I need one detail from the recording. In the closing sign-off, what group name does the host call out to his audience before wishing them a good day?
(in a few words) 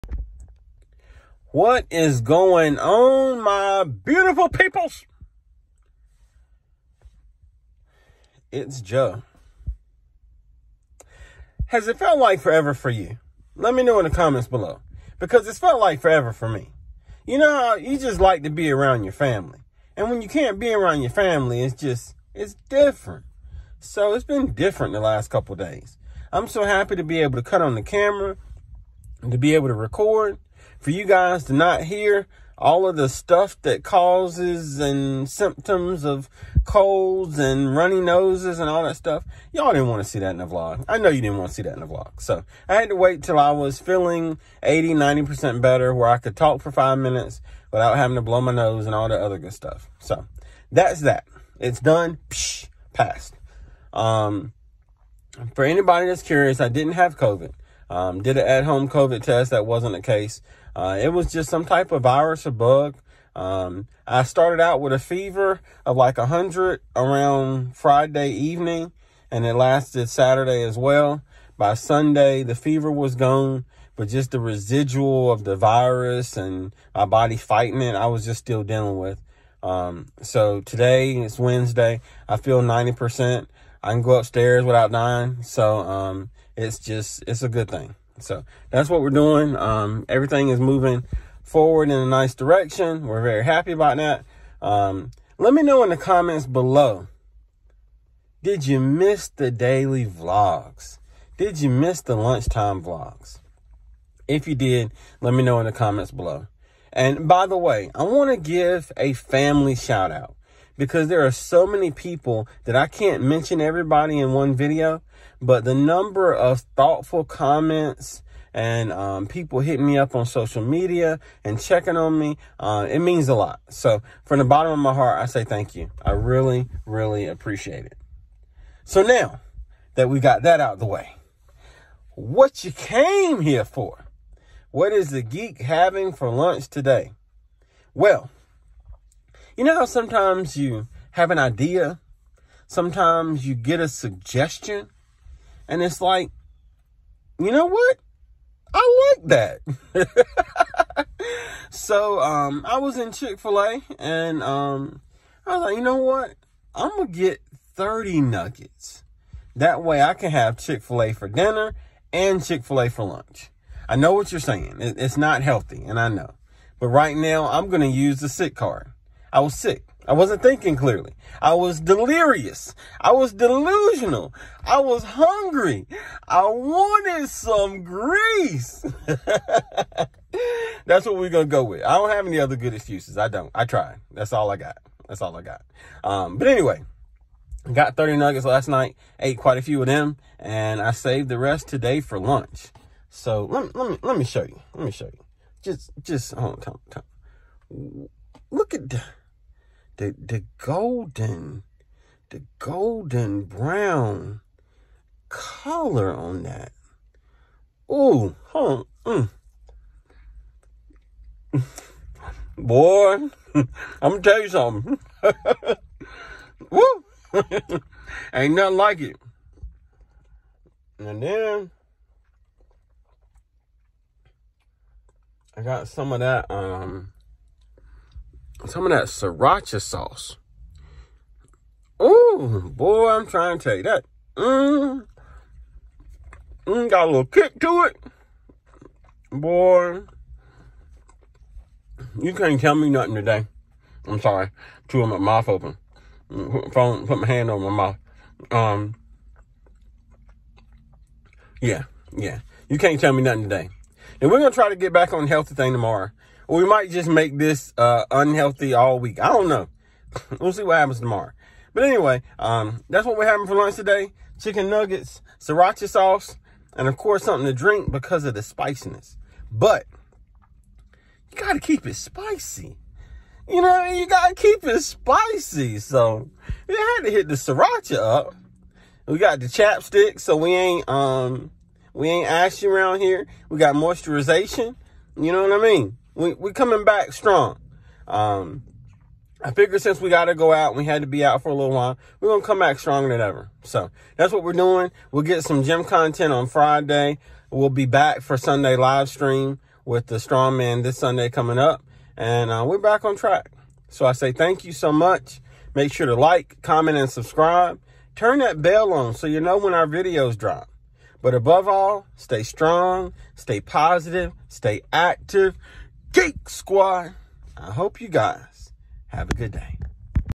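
Geek Squad.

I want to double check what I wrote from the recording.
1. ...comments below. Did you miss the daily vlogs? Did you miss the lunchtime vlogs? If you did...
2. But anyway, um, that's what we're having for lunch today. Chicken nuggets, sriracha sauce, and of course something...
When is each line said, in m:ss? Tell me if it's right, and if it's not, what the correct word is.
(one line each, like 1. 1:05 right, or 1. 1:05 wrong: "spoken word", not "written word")
1. 1:35 right
2. 4:21 right.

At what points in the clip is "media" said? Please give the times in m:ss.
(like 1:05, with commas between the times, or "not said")
2:00.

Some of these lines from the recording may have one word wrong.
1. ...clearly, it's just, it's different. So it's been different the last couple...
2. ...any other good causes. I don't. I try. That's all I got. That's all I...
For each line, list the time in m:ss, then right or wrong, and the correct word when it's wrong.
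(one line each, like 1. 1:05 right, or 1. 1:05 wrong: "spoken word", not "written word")
1. 0:21 wrong: "family", not "clearly"
2. 3:02 wrong: "excuses", not "causes".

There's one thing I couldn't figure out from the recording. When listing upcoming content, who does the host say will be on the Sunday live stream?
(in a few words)
the strong man.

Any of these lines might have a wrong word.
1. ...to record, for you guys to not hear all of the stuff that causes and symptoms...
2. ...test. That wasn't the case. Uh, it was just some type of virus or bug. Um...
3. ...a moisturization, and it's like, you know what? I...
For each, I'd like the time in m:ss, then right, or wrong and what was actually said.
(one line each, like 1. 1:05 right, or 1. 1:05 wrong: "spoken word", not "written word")
1. 0:29 right
2. 0:59 right
3. 2:23 wrong: "suggestion", not "moisturization".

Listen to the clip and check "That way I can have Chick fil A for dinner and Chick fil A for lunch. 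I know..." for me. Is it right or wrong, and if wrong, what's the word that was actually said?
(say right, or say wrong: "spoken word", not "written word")
right.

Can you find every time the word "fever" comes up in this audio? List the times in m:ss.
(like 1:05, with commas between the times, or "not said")
1:04, 1:12.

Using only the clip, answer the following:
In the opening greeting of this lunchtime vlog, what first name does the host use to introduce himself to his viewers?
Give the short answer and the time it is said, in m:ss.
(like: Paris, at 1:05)
Joe, at 0:08.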